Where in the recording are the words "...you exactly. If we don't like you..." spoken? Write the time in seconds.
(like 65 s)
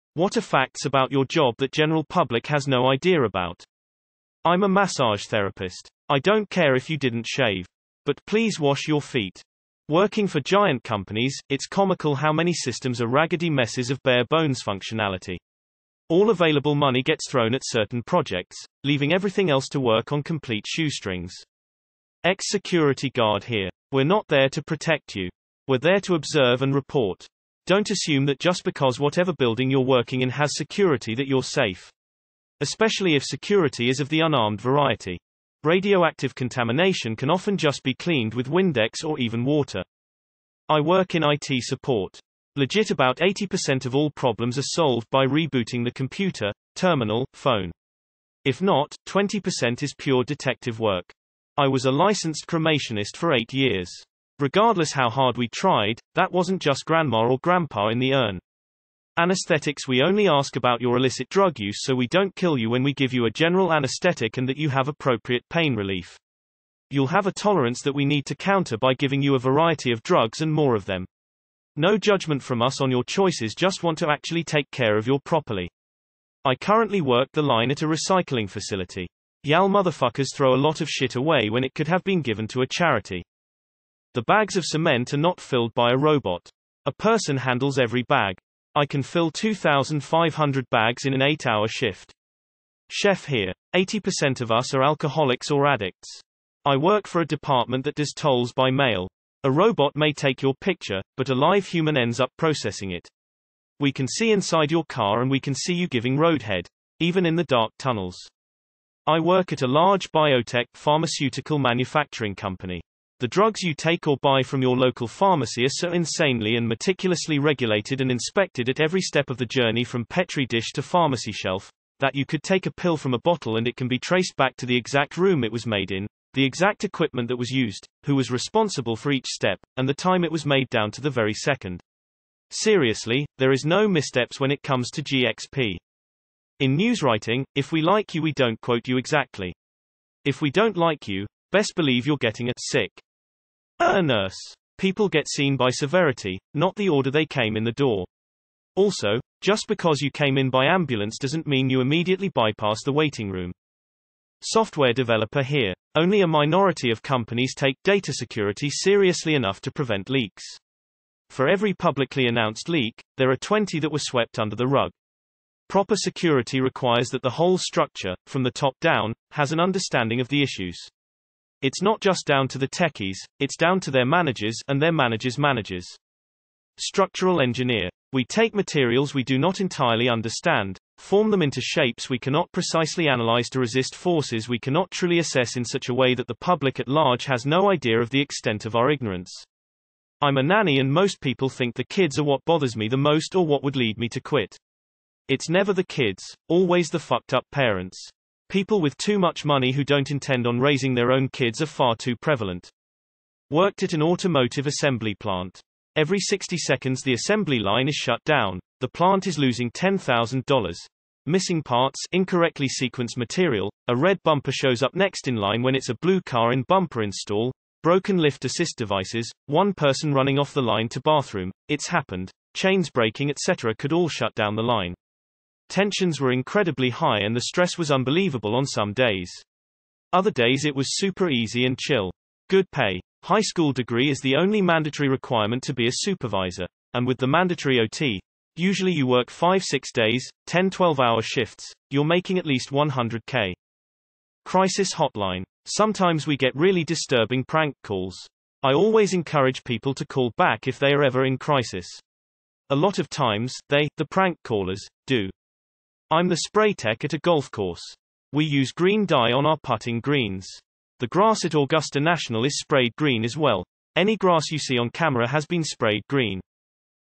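138 s.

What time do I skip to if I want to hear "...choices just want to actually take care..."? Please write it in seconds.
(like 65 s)
73 s.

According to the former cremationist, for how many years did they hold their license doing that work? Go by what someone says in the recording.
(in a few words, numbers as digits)
8.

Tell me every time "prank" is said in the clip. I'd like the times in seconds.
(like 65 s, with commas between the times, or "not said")
247 s, 254 s.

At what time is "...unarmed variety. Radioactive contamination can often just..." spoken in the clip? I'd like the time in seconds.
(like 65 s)
34 s.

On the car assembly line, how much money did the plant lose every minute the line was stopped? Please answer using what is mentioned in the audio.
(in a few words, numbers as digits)
$10,000.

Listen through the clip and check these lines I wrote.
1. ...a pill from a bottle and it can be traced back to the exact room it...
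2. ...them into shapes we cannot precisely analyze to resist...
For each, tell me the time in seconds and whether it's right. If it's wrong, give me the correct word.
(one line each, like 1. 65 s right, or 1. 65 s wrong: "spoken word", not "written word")
1. 122 s right
2. 181 s right.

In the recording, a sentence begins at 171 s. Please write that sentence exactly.
It's not just down to the techies, it's down to their managers and their managers' managers.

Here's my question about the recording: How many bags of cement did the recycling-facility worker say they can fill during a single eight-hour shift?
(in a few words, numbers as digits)
2,500.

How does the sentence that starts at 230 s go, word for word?
Other days it was super easy and chill.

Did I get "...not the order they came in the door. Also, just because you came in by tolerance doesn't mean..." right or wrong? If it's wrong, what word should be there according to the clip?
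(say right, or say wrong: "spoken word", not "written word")
wrong: "ambulance", not "tolerance".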